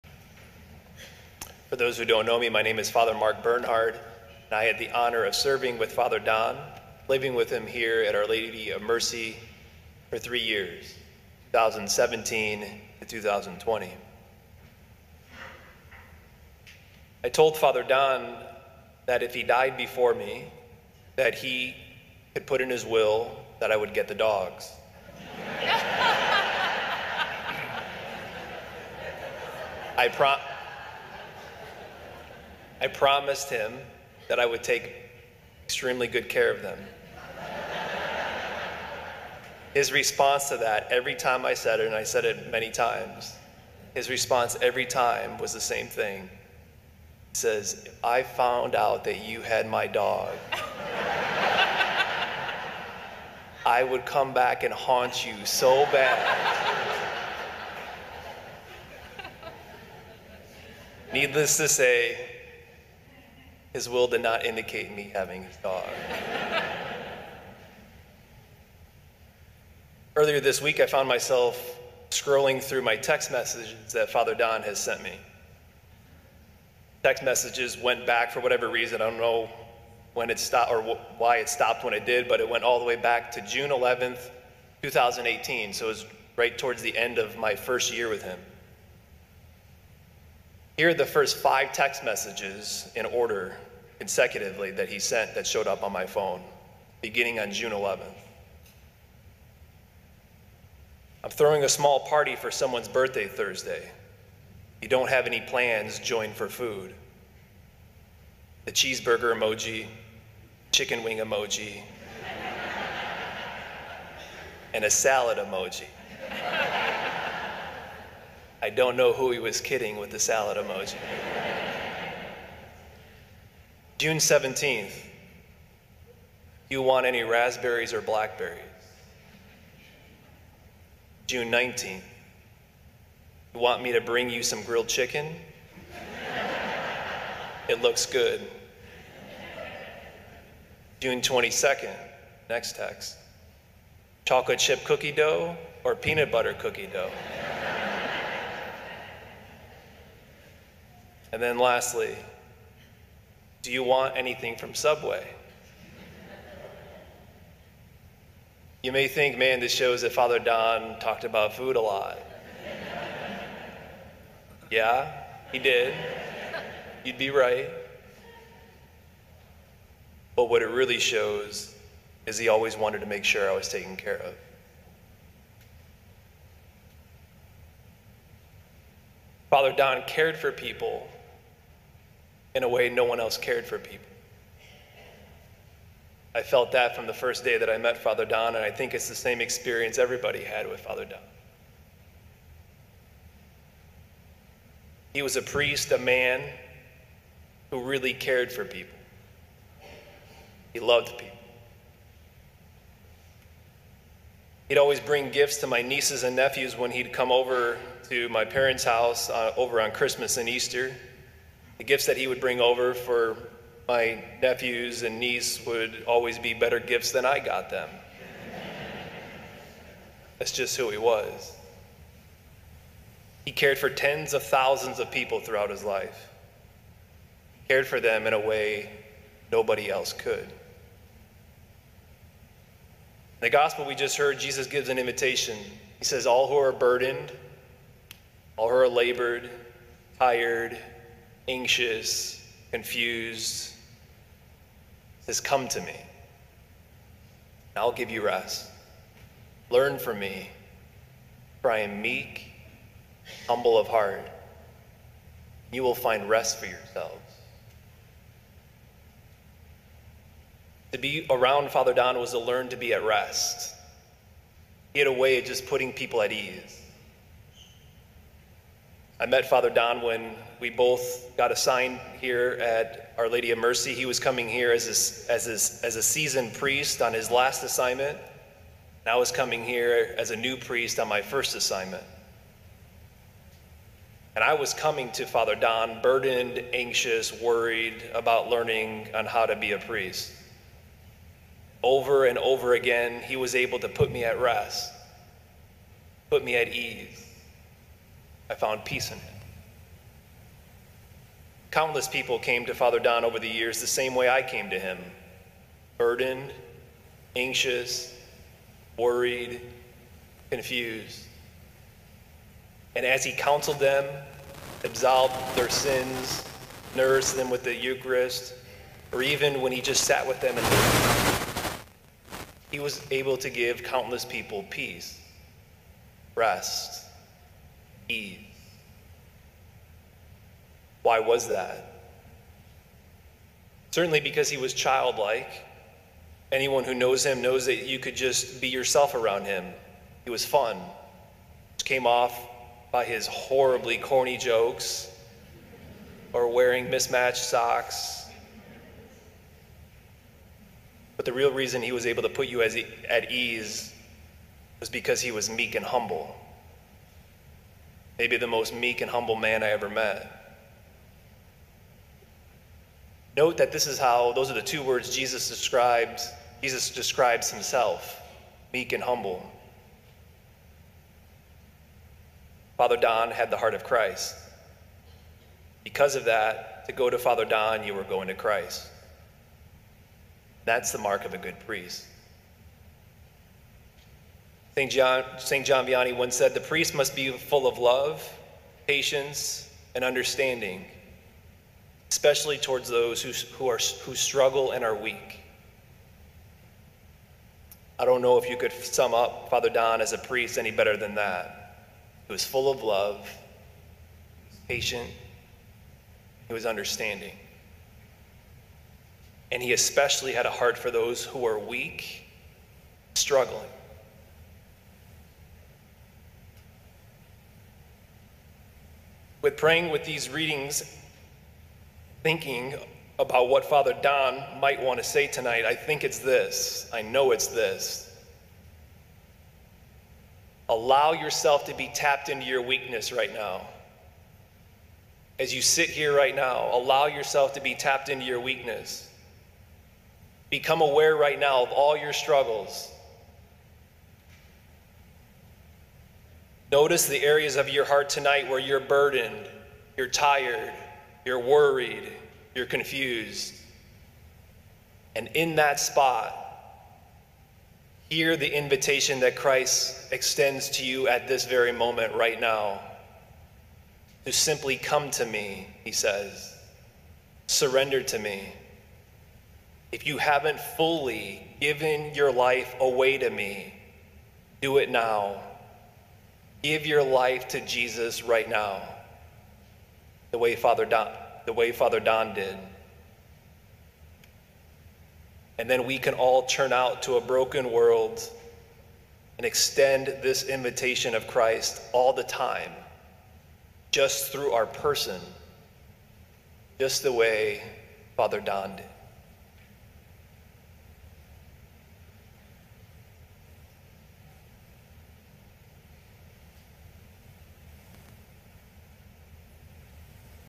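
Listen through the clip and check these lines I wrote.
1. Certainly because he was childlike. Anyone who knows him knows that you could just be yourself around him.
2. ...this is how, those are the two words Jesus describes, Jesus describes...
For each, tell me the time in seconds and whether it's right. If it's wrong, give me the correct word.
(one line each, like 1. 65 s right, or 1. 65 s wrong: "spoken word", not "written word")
1. 333 s right
2. 363 s right.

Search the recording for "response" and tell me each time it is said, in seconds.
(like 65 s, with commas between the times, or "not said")
39 s, 44 s.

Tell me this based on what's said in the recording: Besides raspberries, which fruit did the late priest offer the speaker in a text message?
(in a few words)
Blackberries.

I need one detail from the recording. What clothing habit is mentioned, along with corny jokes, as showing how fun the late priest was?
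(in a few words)
Mismatched socks.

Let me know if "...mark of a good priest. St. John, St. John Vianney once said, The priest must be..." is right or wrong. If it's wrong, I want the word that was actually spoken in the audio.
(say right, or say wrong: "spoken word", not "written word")
right.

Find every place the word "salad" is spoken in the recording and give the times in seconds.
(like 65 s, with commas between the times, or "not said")
114 s, 120 s.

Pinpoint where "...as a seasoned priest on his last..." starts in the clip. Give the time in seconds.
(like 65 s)
275 s.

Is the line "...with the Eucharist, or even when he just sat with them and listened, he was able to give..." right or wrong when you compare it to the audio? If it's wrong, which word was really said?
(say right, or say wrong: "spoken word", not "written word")
right.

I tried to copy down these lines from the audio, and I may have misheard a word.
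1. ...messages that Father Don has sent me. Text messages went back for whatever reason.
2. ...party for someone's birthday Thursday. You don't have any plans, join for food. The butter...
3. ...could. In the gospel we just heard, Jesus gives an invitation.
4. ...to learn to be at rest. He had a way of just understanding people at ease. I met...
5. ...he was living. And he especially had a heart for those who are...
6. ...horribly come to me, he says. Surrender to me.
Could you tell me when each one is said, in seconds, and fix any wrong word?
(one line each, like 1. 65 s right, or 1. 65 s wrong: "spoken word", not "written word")
1. 73 s right
2. 101 s wrong: "cheeseburger", not "butter"
3. 230 s right
4. 262 s wrong: "putting", not "understanding"
5. 406 s wrong: "understanding", not "living"
6. 464 s wrong: "simply", not "horribly".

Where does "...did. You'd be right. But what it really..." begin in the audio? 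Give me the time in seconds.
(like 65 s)
165 s.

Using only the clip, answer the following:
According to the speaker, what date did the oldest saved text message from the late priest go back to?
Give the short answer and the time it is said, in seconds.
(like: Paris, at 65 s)
June 11th, 2018, at 83 s.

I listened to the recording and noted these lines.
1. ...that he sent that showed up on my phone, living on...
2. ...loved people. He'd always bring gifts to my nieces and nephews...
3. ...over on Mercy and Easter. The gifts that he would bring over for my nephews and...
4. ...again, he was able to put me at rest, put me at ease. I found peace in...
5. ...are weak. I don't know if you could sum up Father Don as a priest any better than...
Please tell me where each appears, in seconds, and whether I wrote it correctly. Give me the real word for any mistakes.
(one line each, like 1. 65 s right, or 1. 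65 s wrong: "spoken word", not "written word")
1. 94 s wrong: "beginning", not "living"
2. 200 s right
3. 209 s wrong: "Christmas", not "Mercy"
4. 292 s right
5. 394 s right.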